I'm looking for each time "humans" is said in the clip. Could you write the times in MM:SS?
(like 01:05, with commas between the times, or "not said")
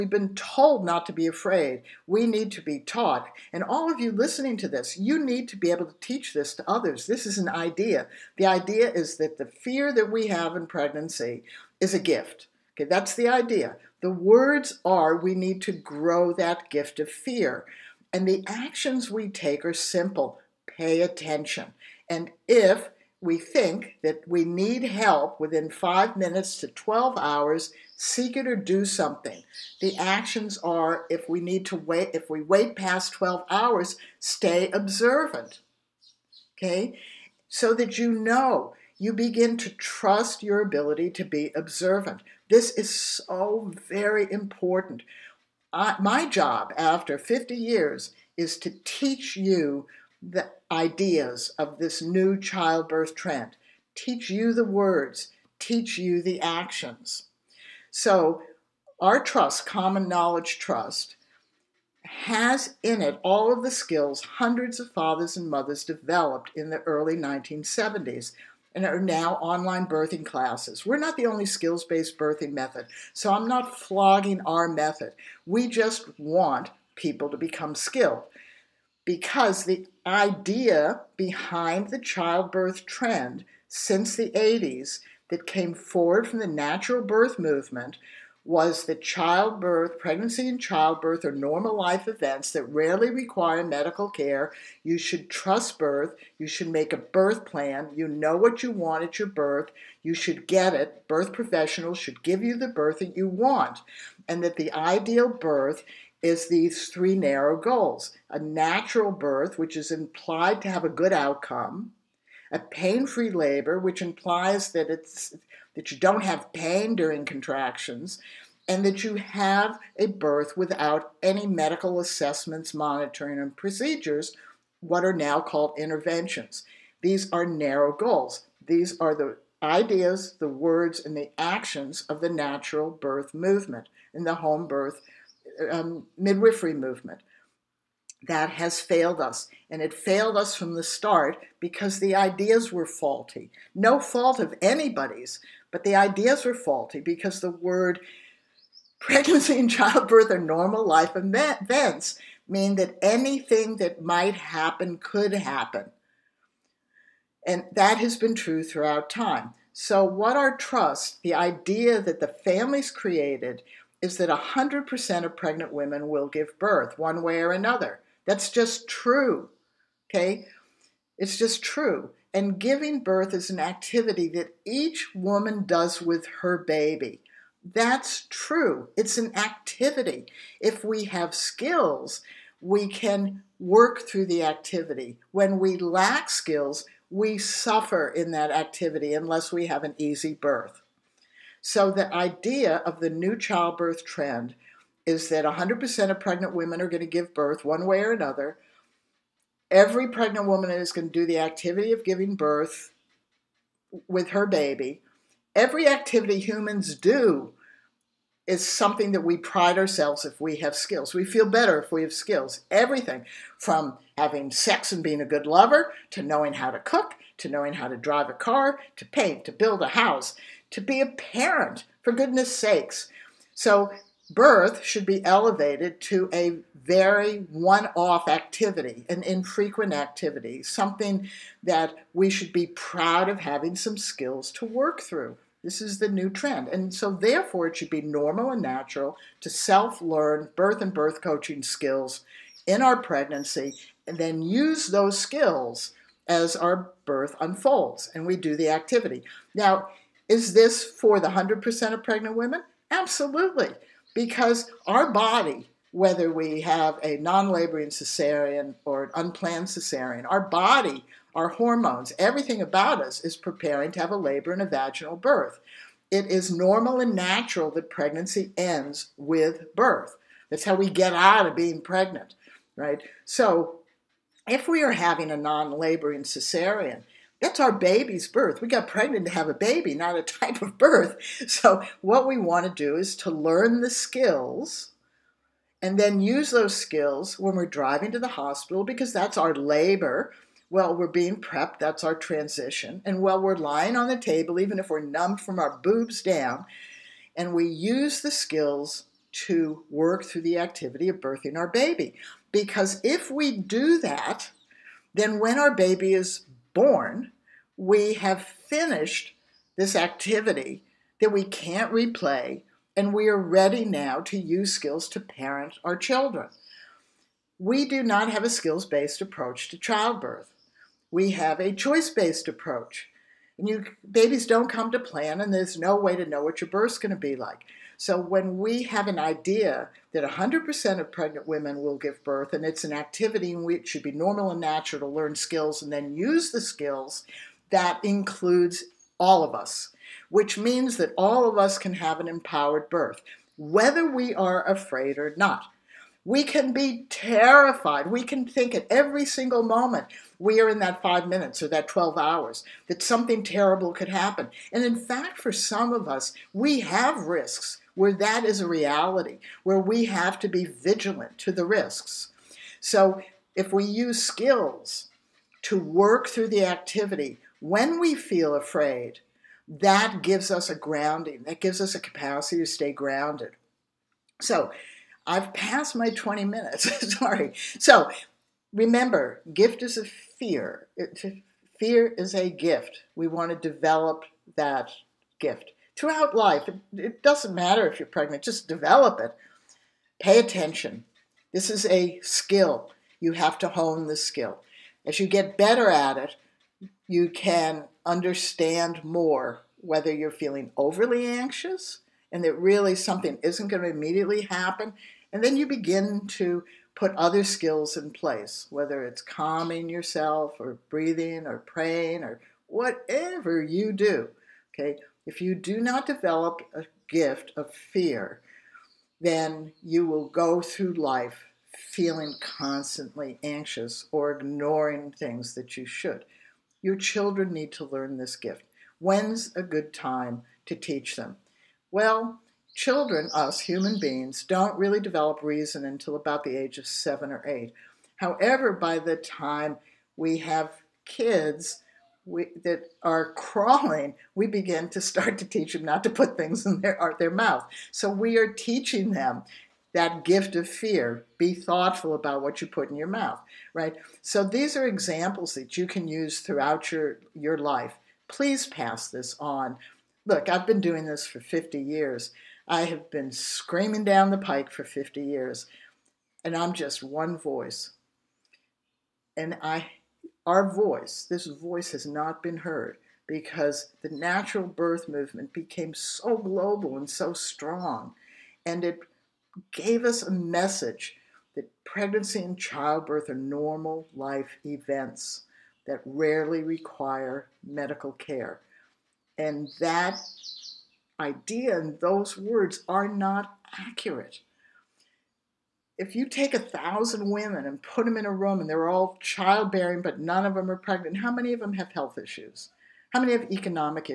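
03:26, 07:13.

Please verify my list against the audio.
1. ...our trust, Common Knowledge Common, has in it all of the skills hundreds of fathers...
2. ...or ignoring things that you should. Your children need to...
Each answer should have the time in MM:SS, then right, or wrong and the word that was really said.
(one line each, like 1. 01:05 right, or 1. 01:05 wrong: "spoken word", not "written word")
1. 00:58 wrong: "Trust", not "Common"
2. 07:04 right.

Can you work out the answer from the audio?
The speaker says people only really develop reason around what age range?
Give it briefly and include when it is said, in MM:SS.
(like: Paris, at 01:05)
7 or 8, at 07:16.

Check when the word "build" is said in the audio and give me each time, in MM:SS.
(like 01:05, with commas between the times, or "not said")
03:39.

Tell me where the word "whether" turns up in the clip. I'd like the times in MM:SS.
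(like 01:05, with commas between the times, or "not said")
04:15, 05:43, 06:39, 06:48.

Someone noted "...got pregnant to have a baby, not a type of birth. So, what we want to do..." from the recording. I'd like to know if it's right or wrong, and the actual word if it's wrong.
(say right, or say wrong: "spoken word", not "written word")
right.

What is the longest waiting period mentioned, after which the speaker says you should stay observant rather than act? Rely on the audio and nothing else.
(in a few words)
12 hours.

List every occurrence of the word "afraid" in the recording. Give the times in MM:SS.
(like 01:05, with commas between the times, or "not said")
00:01, 05:44, 06:08.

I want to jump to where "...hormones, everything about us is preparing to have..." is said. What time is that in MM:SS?
04:21.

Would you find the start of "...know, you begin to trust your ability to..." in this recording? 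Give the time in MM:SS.
00:38.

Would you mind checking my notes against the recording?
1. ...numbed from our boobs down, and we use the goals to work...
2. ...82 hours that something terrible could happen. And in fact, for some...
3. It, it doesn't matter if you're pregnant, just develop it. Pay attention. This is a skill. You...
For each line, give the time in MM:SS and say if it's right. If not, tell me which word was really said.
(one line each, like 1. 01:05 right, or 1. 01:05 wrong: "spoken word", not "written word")
1. 04:55 wrong: "skills", not "goals"
2. 05:51 wrong: "12", not "82"
3. 06:26 right.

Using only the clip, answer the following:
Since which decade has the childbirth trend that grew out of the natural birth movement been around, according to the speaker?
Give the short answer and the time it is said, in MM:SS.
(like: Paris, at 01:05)
1980s, at 01:24.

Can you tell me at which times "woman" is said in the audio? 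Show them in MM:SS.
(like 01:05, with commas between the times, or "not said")
02:55, 03:20.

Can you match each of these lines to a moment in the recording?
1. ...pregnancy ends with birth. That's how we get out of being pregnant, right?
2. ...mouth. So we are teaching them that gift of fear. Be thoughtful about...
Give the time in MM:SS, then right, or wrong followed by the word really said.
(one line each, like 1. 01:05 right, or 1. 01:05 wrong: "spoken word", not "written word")
1. 04:27 right
2. 07:27 right.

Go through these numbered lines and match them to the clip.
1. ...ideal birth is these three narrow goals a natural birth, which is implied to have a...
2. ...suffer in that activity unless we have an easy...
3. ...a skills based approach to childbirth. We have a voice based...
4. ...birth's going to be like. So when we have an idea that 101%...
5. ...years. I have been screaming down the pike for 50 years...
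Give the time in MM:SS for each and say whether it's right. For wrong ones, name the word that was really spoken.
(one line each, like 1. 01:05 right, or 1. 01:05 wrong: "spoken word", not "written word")
1. 01:44 right
2. 03:07 right
3. 05:18 wrong: "choice", not "voice"
4. 05:26 wrong: "100", not "101"
5. 07:41 right.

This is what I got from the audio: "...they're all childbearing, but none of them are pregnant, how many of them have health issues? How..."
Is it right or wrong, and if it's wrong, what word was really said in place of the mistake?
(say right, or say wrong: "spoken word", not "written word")
right.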